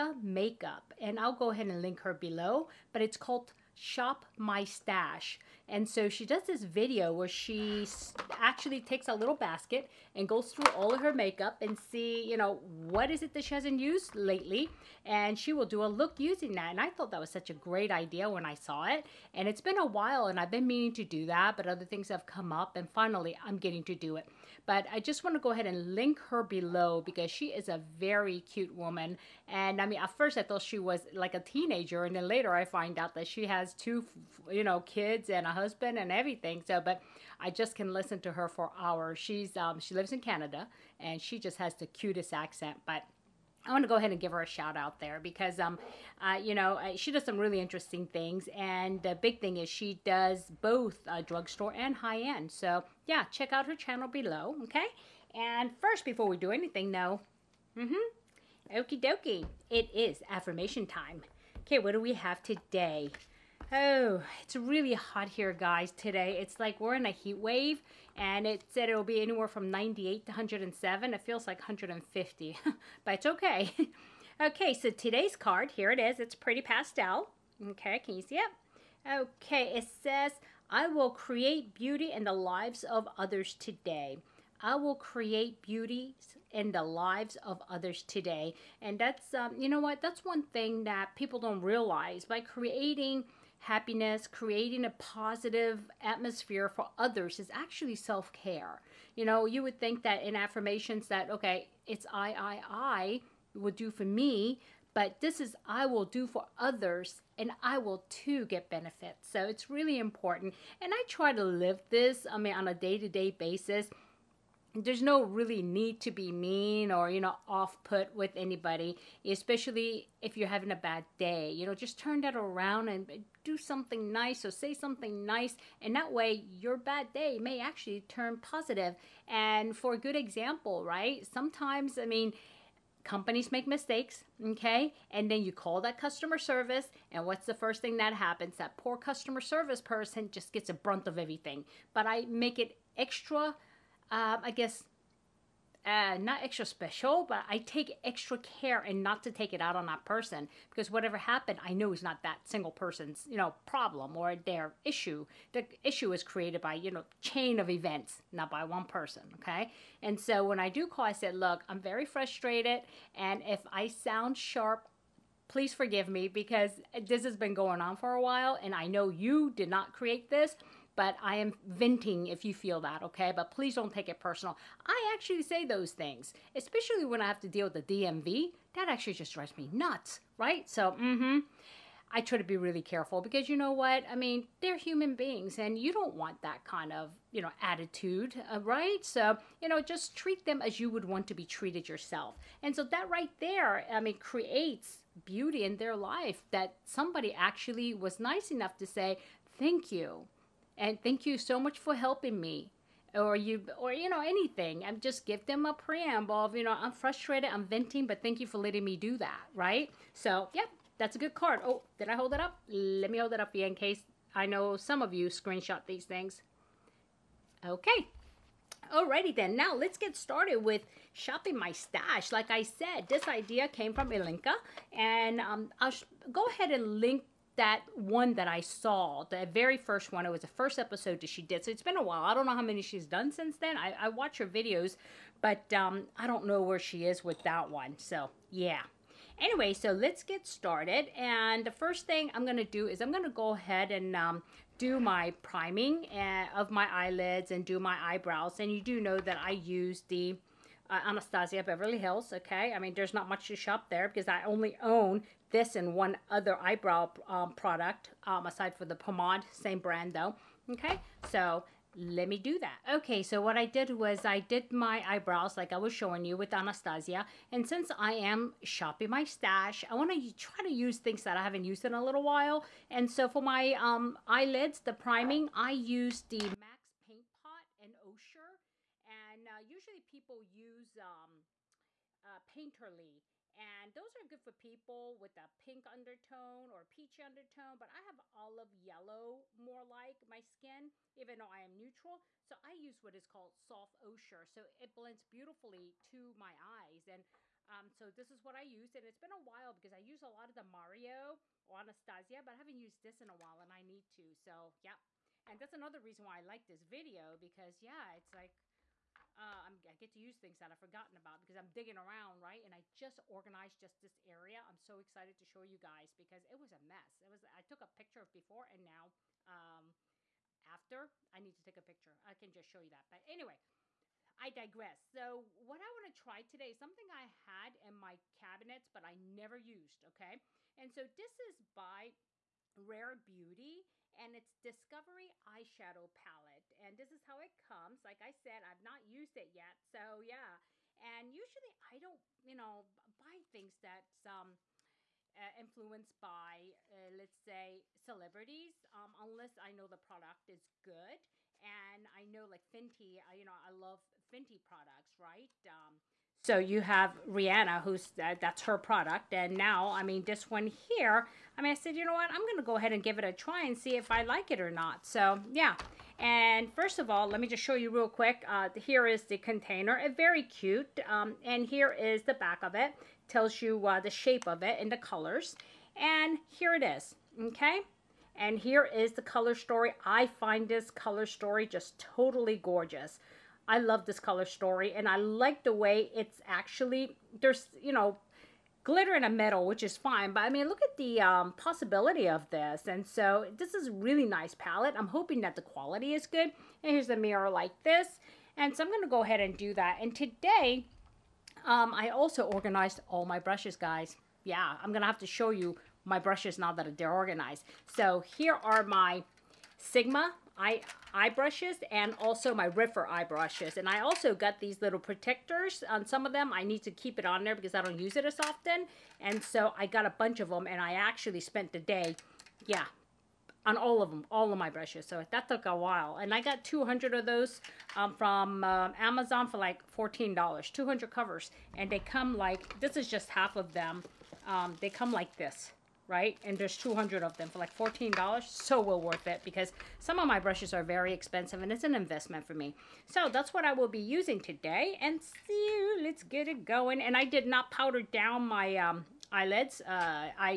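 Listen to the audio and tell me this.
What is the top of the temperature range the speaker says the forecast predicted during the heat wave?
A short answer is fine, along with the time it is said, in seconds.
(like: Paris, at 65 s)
107, at 70 s.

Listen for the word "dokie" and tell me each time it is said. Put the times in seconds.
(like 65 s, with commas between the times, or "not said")
59 s.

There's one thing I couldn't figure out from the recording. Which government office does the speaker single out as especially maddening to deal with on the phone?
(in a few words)
DMV.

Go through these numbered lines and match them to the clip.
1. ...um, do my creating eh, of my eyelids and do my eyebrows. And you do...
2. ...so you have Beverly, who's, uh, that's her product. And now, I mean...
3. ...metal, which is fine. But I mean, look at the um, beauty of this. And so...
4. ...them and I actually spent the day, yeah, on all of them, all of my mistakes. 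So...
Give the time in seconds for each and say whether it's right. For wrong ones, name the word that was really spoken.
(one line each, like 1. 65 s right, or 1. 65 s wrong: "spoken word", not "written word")
1. 244 s wrong: "priming", not "creating"
2. 356 s wrong: "Rihanna", not "Beverly"
3. 389 s wrong: "possibility", not "beauty"
4. 420 s wrong: "brushes", not "mistakes".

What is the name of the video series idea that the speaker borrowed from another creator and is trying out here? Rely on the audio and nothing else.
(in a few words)
Shop My Stash.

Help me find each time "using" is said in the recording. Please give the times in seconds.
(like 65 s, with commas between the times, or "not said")
16 s, 443 s.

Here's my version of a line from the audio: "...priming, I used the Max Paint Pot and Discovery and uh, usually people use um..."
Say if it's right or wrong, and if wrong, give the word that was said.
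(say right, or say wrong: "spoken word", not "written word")
wrong: "Osher", not "Discovery".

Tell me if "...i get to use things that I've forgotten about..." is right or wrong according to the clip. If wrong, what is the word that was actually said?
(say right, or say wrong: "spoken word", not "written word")
right.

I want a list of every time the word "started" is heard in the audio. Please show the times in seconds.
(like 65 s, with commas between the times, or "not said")
220 s, 240 s.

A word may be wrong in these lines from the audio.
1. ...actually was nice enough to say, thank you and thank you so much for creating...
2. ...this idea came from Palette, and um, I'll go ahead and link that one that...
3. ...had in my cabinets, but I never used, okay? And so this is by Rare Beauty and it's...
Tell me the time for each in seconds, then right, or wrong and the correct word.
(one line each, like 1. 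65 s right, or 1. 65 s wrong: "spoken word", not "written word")
1. 197 s wrong: "helping", not "creating"
2. 223 s wrong: "Ilinca", not "Palette"
3. 327 s right.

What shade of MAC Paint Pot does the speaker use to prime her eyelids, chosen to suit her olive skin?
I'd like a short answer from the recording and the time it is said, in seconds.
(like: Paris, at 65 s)
Soft Ochre, at 293 s.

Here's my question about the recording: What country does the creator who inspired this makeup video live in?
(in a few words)
Canada.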